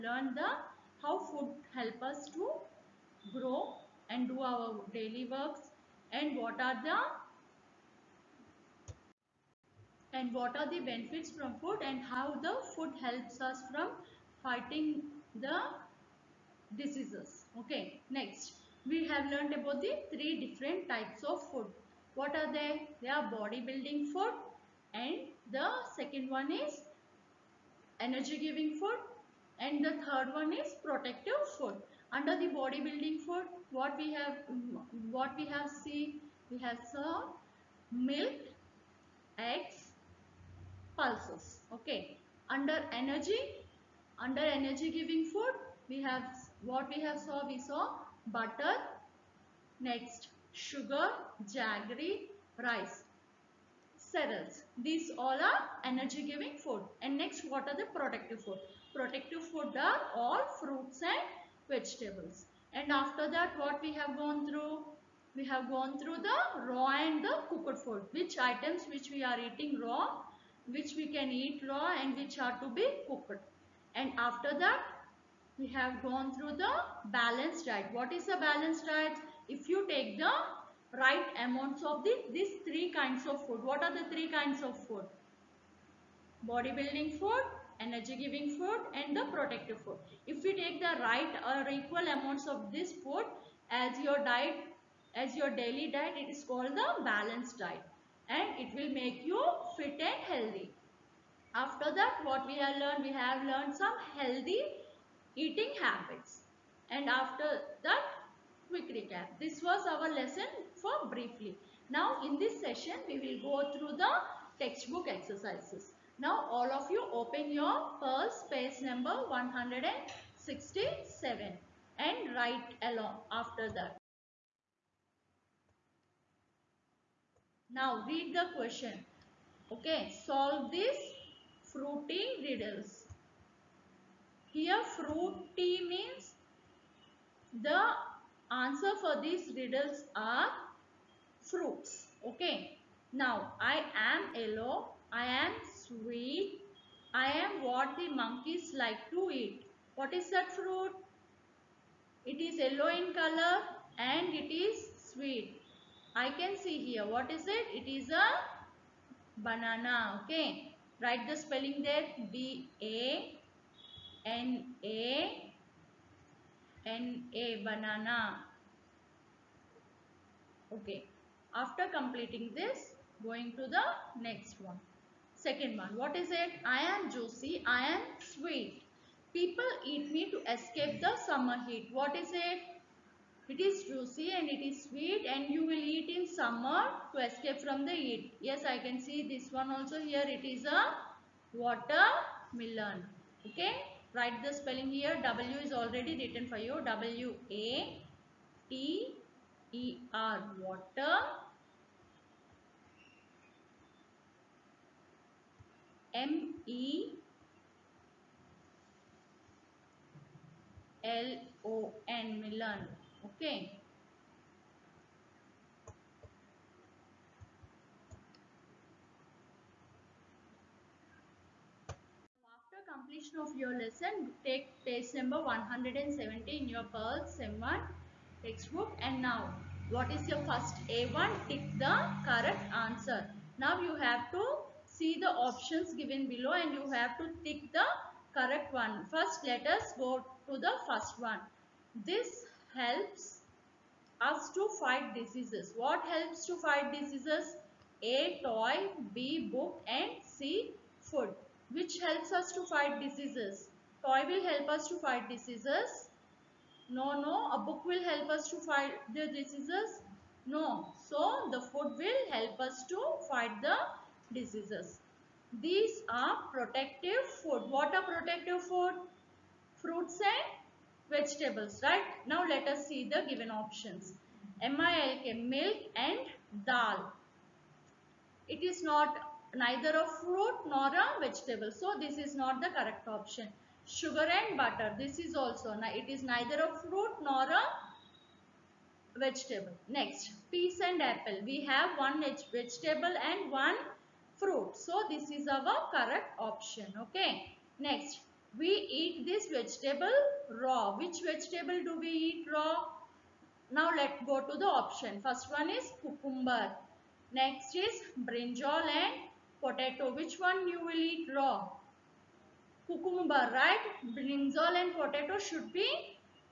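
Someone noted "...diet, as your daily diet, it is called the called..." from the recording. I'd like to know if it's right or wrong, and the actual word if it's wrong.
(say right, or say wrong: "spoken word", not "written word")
wrong: "balanced", not "called".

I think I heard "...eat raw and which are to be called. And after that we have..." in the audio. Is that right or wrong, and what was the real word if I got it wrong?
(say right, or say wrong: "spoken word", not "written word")
wrong: "cooked", not "called".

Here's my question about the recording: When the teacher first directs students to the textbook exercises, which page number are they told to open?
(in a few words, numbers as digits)
167.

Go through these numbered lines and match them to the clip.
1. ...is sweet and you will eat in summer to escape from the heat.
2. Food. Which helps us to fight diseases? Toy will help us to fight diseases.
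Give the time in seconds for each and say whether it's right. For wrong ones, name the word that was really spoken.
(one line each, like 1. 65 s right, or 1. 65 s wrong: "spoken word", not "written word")
1. 184 s right
2. 251 s right.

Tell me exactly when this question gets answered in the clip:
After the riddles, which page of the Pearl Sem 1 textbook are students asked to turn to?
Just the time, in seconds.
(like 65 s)
225 s.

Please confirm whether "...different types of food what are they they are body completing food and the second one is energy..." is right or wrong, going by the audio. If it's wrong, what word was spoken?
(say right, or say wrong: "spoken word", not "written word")
wrong: "building", not "completing".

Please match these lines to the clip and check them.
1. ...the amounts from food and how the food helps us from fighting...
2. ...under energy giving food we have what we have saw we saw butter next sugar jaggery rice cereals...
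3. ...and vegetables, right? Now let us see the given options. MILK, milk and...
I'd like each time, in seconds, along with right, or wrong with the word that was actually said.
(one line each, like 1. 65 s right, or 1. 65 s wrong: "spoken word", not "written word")
1. 10 s wrong: "benefits", not "amounts"
2. 44 s right
3. 270 s right.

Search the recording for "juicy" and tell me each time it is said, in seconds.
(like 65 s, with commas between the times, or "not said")
177 s, 183 s.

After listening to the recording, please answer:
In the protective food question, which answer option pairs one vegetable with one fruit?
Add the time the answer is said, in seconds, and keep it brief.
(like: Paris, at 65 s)
Peas and apple, at 290 s.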